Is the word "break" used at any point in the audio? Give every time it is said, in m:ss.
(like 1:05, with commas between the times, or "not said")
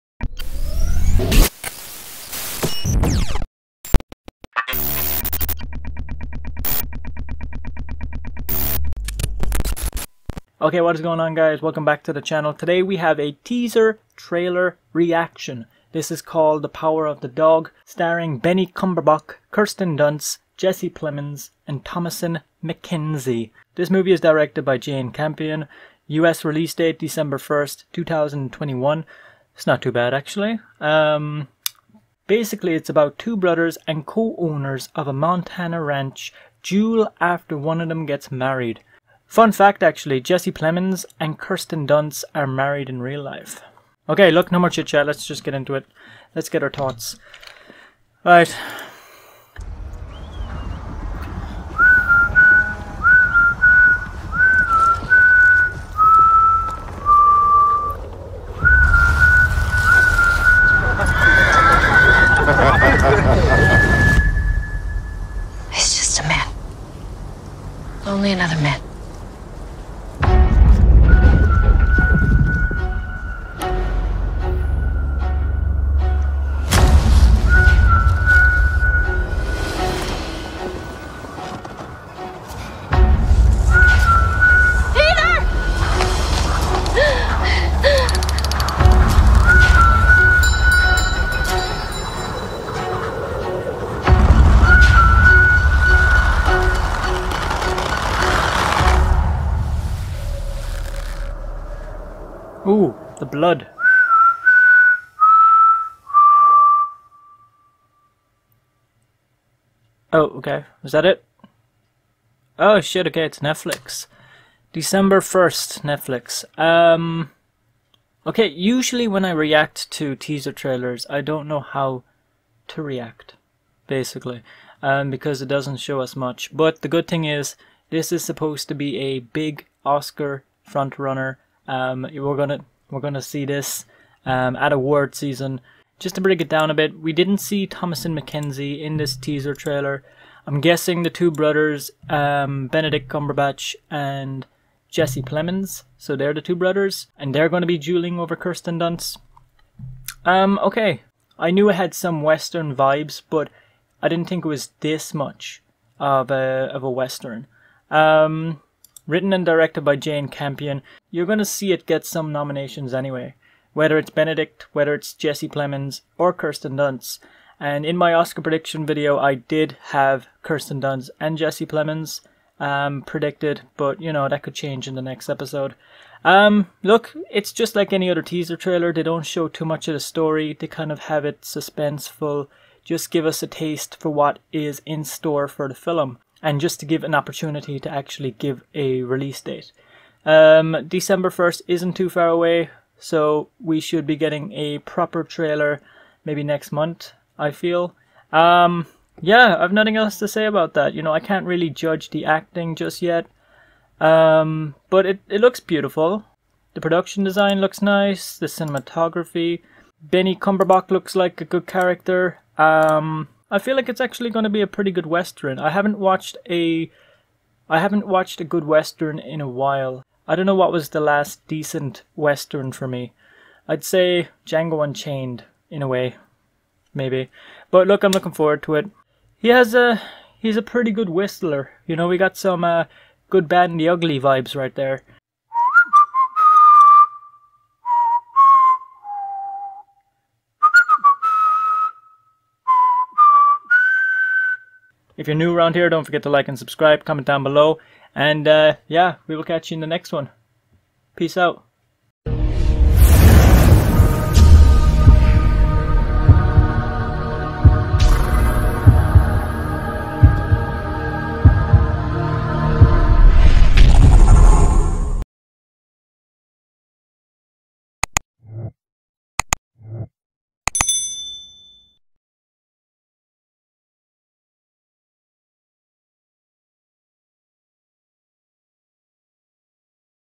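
2:16.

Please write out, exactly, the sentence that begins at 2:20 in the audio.
I'm guessing the two brothers, um, Benedict Cumberbatch and Jesse Plemons.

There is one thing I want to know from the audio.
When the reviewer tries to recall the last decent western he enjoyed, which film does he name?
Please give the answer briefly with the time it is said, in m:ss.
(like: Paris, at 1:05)
Django Unchained, at 3:44.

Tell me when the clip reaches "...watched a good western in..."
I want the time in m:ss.
3:38.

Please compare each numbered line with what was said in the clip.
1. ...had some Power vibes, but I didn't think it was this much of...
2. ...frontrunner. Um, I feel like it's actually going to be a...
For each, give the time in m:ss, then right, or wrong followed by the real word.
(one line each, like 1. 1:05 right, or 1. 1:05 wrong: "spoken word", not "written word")
1. 2:31 wrong: "Western", not "Power"
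2. 3:31 wrong: "character", not "frontrunner".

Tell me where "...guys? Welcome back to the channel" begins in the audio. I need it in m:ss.
0:11.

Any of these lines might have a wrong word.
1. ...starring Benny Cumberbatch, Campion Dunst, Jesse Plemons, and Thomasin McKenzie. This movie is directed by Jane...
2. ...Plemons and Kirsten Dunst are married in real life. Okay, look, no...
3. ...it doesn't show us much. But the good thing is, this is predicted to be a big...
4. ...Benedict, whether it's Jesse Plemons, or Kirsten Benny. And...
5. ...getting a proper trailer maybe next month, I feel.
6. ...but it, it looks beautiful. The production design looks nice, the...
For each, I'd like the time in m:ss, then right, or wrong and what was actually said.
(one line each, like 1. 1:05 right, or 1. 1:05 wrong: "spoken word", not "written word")
1. 0:17 wrong: "Kirsten", not "Campion"
2. 0:40 right
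3. 2:05 wrong: "supposed", not "predicted"
4. 2:44 wrong: "Dunst", not "Benny"
5. 3:14 right
6. 3:24 right.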